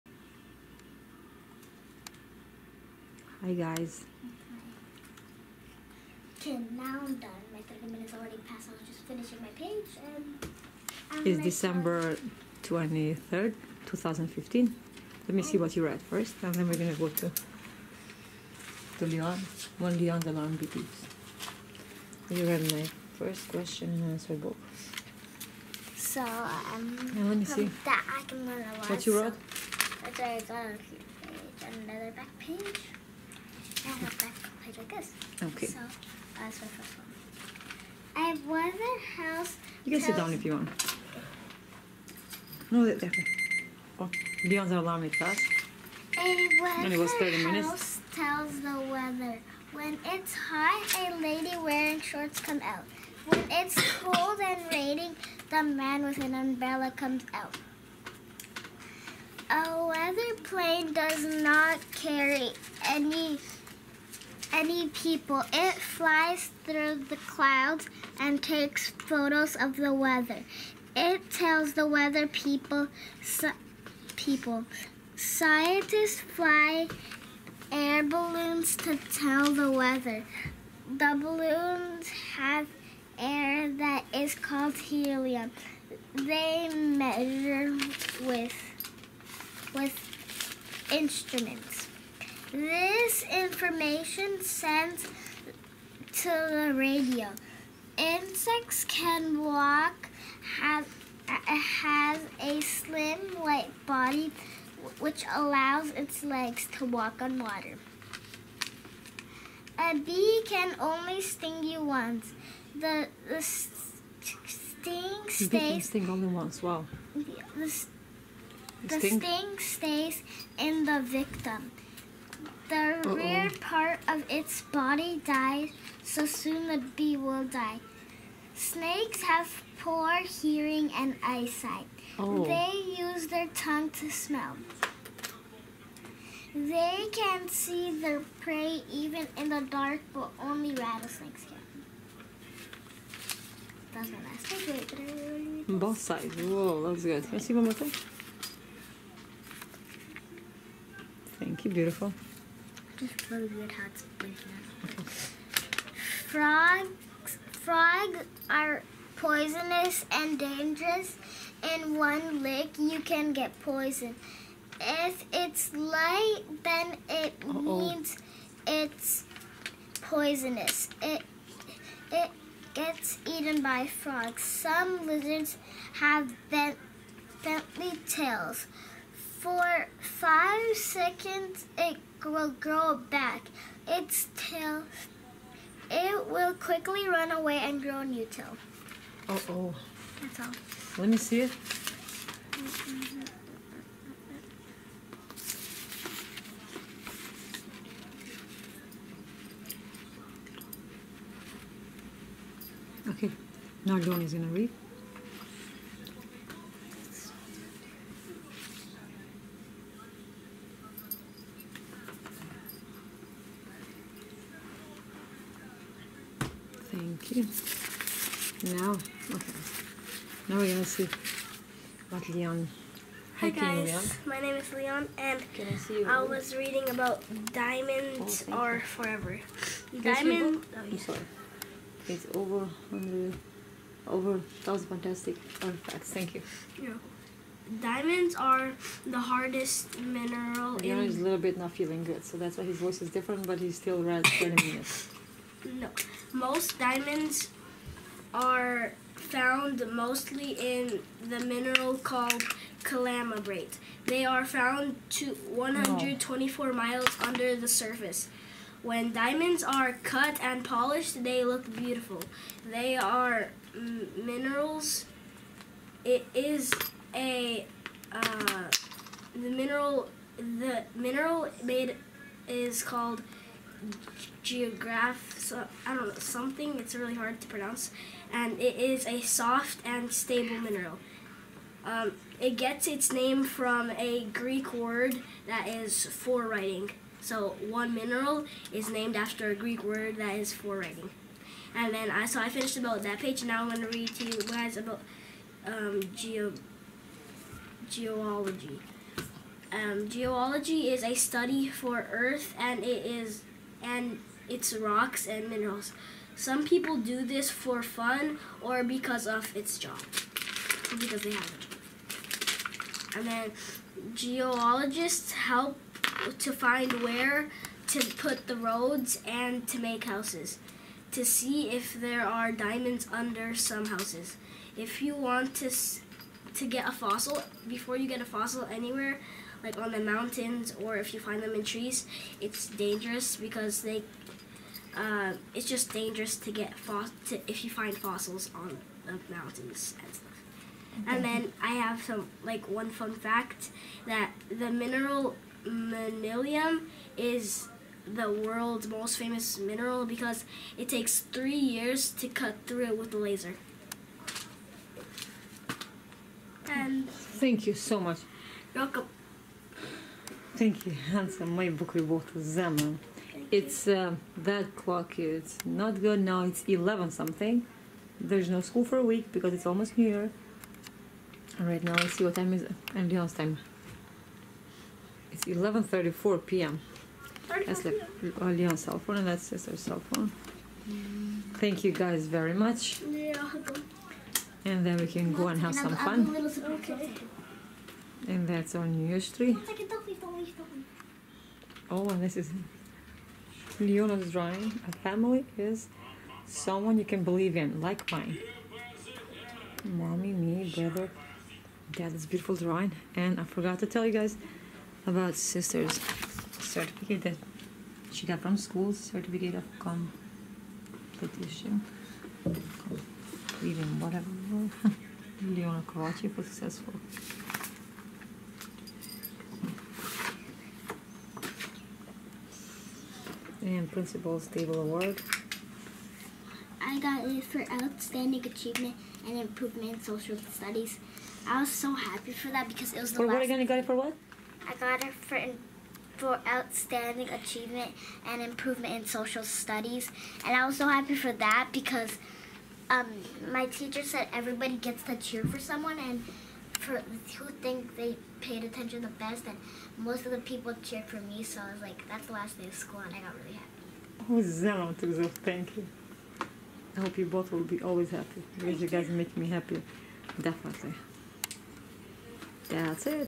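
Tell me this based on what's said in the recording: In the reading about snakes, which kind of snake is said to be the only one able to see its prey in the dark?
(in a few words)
rattlesnakes.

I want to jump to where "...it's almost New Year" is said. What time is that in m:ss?
6:09.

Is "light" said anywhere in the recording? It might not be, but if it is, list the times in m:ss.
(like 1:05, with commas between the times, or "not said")
1:43, 2:45.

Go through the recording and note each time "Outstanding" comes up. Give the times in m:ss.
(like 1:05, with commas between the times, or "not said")
7:07, 7:16.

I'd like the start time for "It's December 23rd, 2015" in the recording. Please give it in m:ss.
0:11.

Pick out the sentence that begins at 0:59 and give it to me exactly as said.
A weather plane does not carry any any people.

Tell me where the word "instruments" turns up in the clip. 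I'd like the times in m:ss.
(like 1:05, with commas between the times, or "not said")
1:30.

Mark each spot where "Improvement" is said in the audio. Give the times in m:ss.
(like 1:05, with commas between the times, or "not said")
7:09, 7:18.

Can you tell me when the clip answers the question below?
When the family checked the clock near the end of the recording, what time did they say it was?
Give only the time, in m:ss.
6:15.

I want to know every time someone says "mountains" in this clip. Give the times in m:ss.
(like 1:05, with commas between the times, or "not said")
5:29, 5:39.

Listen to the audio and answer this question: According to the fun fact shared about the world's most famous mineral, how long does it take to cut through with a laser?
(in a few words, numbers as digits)
3 years.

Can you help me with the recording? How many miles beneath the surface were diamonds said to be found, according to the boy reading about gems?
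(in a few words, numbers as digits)
124.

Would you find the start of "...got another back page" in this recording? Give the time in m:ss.
0:30.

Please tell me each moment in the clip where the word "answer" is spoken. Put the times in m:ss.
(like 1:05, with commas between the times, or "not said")
0:24.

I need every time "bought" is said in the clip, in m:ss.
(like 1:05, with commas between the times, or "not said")
6:02.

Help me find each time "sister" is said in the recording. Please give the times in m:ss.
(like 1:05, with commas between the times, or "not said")
6:19, 6:45.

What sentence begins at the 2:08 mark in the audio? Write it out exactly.
Snakes have poor hearing and eyesight.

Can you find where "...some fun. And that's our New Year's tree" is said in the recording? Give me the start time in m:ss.
6:25.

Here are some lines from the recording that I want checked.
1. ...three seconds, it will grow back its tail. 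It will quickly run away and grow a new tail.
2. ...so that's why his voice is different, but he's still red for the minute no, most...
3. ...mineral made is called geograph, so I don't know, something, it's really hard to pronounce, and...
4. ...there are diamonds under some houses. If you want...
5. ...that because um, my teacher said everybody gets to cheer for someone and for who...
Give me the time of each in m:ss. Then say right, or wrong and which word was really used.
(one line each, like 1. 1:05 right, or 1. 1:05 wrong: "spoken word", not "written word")
1. 2:59 wrong: "five", not "three"
2. 4:02 right
3. 4:30 right
4. 5:21 right
5. 7:21 right.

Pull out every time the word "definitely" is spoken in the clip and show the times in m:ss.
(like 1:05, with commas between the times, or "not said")
0:42, 7:40.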